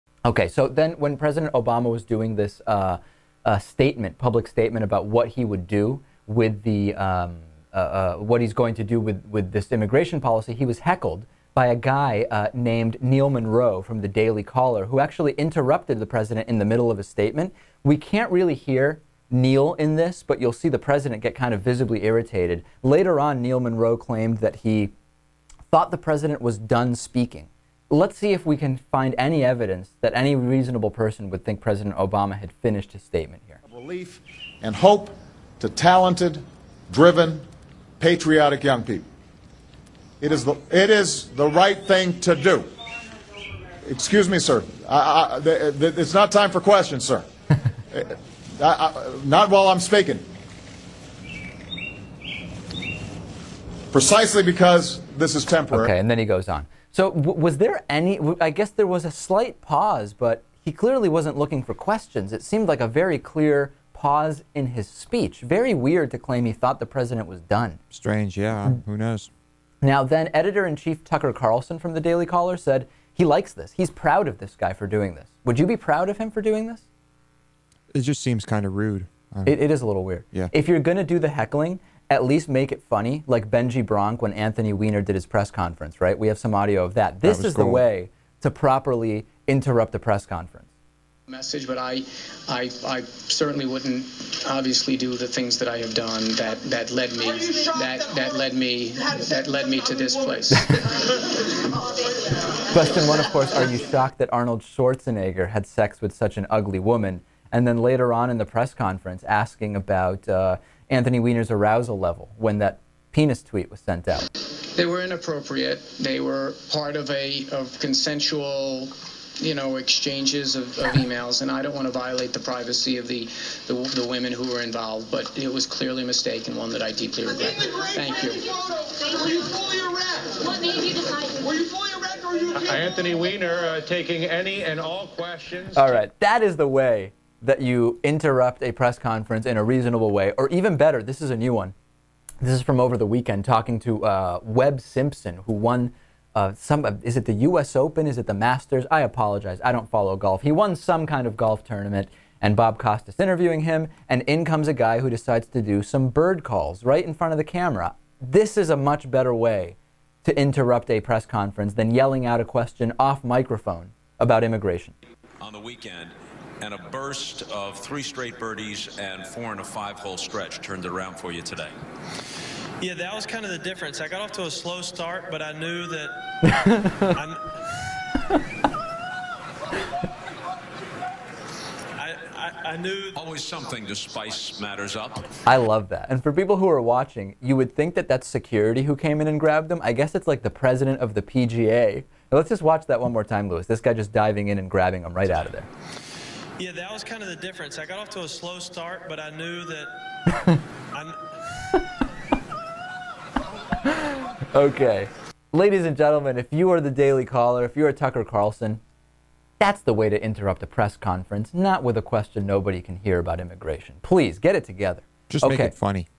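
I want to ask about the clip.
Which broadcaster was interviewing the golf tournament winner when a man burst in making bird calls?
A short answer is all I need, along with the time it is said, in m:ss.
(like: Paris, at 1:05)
Bob Costas, at 2:32.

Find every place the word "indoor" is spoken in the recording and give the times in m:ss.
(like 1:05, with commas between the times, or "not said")
not said.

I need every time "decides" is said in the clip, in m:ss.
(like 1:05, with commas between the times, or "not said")
2:35.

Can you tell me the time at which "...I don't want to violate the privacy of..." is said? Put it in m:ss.
2:01.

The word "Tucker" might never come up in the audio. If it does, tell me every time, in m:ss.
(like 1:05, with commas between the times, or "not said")
1:11, 3:27.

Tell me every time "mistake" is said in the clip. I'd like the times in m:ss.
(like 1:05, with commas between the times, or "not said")
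2:06.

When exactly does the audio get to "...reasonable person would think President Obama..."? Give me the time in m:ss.
0:30.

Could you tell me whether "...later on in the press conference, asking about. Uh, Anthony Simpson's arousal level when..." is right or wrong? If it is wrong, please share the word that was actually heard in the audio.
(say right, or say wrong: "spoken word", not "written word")
wrong: "Weiner", not "Simpson".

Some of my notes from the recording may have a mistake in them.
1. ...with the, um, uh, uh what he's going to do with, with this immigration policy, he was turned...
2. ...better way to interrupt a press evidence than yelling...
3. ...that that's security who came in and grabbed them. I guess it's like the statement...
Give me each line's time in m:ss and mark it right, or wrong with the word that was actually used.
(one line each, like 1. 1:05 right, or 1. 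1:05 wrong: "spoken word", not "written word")
1. 0:06 wrong: "heckled", not "turned"
2. 2:39 wrong: "conference", not "evidence"
3. 3:07 wrong: "president", not "statement".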